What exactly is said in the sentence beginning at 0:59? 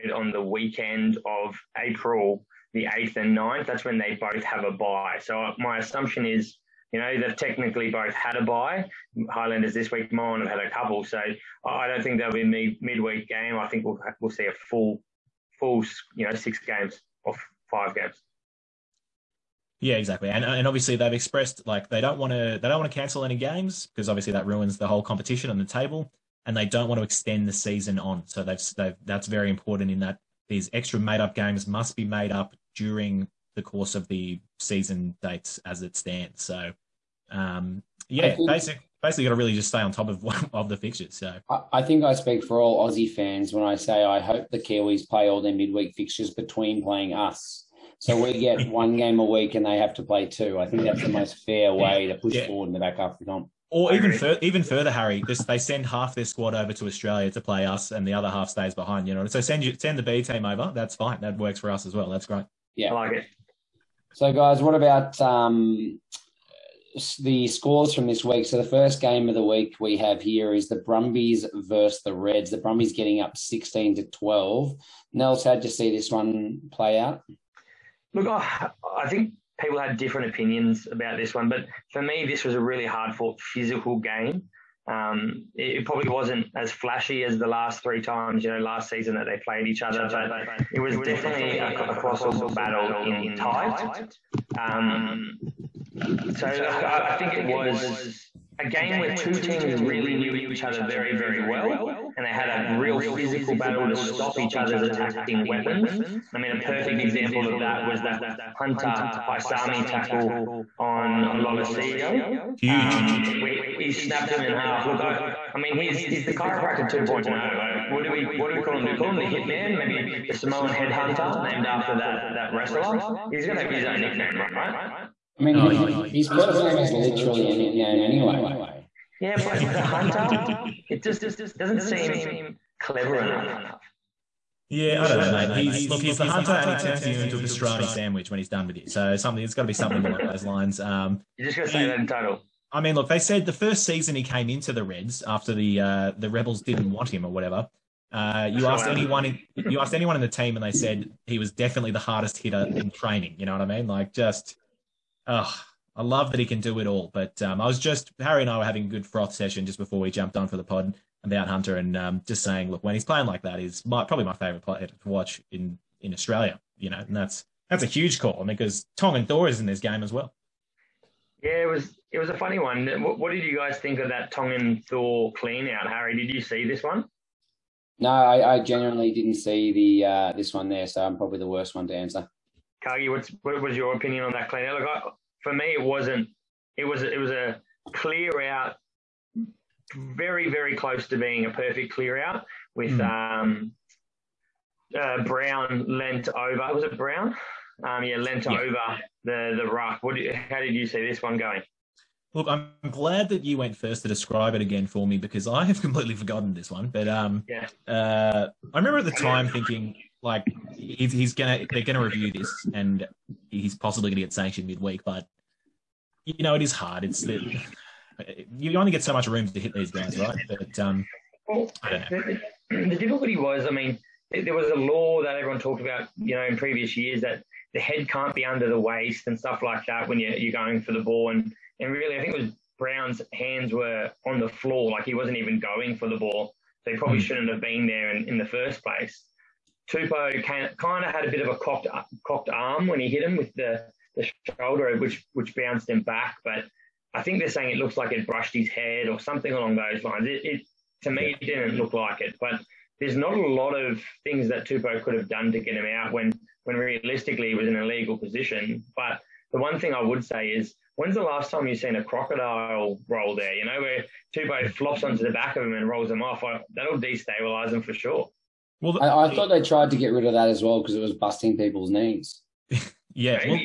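You know, so send you, send the B team over.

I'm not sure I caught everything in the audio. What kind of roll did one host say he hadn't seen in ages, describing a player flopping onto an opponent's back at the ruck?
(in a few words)
Crocodile roll.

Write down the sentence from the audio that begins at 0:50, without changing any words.
I think that's the most fair way yeah, to push yeah.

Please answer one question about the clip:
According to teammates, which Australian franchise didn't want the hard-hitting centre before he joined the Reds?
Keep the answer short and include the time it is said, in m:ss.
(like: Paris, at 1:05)
The Rebels, at 2:26.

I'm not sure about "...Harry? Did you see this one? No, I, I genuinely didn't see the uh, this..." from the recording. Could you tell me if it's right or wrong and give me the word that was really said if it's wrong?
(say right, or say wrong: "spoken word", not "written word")
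right.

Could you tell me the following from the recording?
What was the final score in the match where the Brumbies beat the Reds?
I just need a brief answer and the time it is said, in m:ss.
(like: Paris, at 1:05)
16-12, at 1:13.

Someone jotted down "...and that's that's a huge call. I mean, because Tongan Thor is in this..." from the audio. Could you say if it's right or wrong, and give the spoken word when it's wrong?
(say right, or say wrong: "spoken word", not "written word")
right.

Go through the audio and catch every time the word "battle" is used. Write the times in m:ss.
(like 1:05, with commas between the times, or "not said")
1:32, 1:43.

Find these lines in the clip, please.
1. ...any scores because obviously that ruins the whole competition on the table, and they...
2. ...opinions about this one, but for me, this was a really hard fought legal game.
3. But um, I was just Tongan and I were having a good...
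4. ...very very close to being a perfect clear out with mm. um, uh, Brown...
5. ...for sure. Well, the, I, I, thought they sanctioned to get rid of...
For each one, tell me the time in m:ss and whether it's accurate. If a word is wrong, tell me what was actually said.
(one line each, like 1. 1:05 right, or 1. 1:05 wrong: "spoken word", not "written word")
1. 0:23 wrong: "games", not "scores"
2. 1:20 wrong: "physical", not "legal"
3. 2:37 wrong: "Harry", not "Tongan"
4. 3:09 right
5. 4:27 wrong: "tried", not "sanctioned".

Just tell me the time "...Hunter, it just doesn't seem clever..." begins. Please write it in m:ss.
2:09.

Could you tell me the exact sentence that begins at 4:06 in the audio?
But I think they're saying it looks like it brushed his head or something along those lines.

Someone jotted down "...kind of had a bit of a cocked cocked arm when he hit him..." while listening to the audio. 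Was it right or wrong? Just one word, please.
right.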